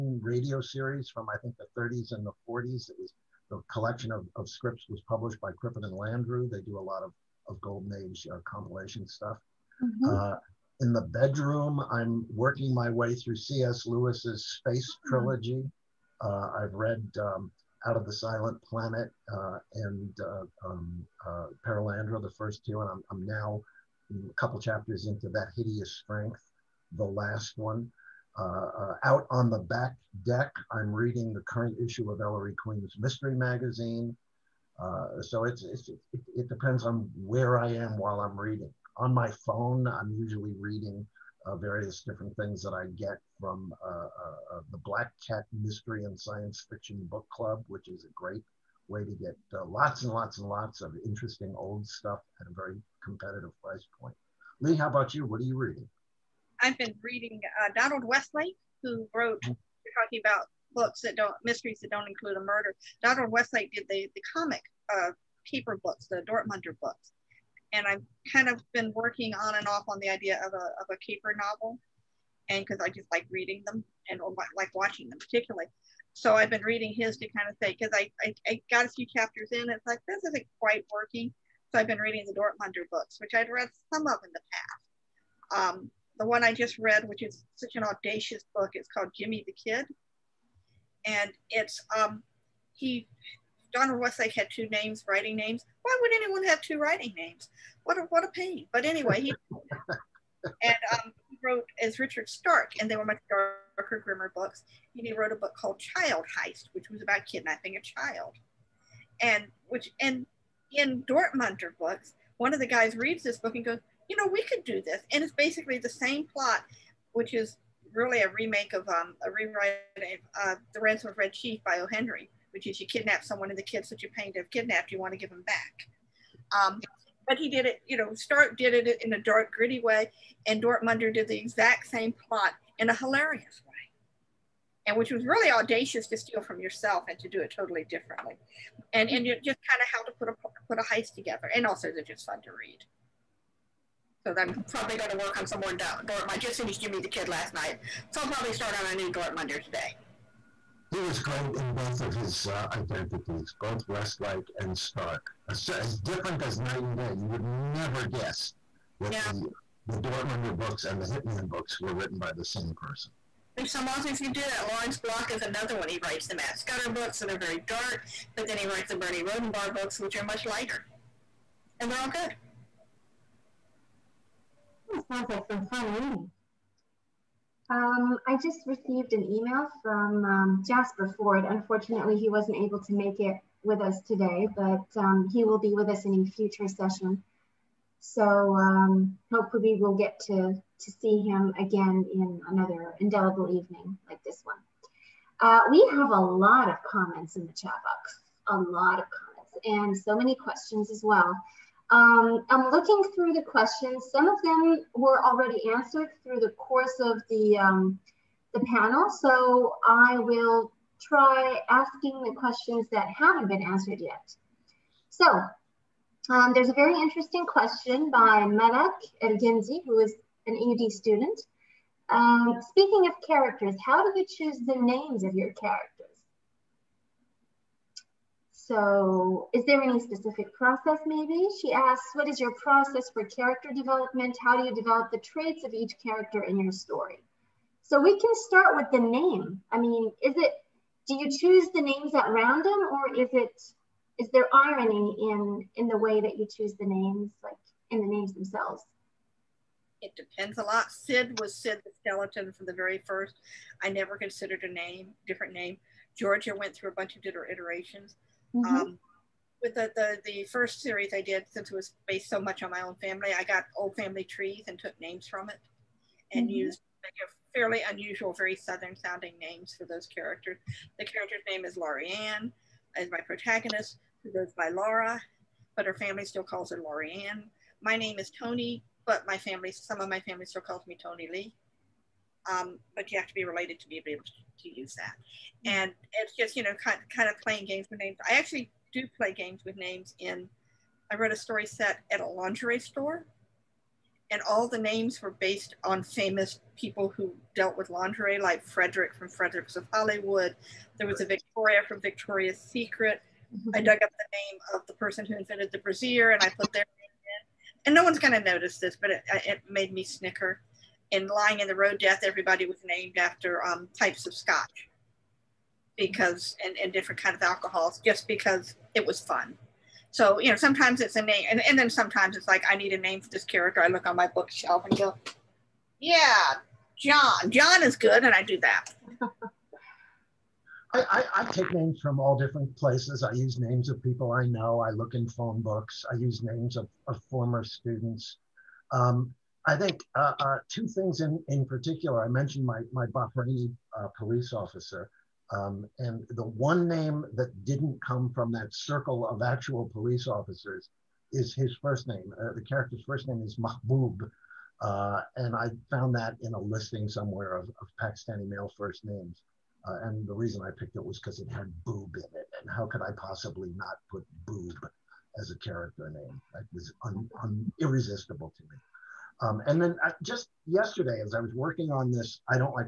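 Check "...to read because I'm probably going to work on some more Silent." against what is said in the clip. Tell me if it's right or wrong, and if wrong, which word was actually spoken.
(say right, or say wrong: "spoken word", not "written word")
wrong: "Dortmund", not "Silent".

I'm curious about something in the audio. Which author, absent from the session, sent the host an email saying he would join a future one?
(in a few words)
Jasper Fforde.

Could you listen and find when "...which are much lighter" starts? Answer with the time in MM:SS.
02:50.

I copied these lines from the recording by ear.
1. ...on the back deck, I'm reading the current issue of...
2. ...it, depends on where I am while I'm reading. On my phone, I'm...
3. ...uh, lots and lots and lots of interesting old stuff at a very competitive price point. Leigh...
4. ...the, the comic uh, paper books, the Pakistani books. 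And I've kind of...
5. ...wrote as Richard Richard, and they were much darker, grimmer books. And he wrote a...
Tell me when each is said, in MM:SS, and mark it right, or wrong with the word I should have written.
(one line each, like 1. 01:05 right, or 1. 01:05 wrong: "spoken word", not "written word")
1. 00:29 right
2. 00:36 right
3. 00:49 right
4. 01:03 wrong: "Dortmunder", not "Pakistani"
5. 01:41 wrong: "Stark", not "Richard".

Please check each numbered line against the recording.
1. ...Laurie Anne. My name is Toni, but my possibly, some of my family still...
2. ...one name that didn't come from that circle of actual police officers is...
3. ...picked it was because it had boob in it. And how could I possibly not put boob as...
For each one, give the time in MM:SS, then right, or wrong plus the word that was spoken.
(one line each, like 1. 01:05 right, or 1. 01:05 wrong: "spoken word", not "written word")
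1. 04:36 wrong: "family", not "possibly"
2. 05:46 right
3. 06:00 right.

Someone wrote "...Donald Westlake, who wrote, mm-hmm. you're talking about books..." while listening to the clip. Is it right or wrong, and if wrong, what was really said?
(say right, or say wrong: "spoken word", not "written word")
right.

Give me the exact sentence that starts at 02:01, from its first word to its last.
Henry, which is you kidnap someone and the kids that you're paying to have kidnapped, you want to give them back.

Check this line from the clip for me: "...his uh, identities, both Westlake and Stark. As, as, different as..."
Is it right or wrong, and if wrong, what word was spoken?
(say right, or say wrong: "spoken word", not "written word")
right.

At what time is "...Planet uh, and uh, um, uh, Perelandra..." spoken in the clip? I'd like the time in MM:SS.
00:18.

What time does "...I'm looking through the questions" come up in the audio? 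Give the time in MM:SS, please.
03:22.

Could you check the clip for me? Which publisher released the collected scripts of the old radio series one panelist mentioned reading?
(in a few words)
Crippen and Landru.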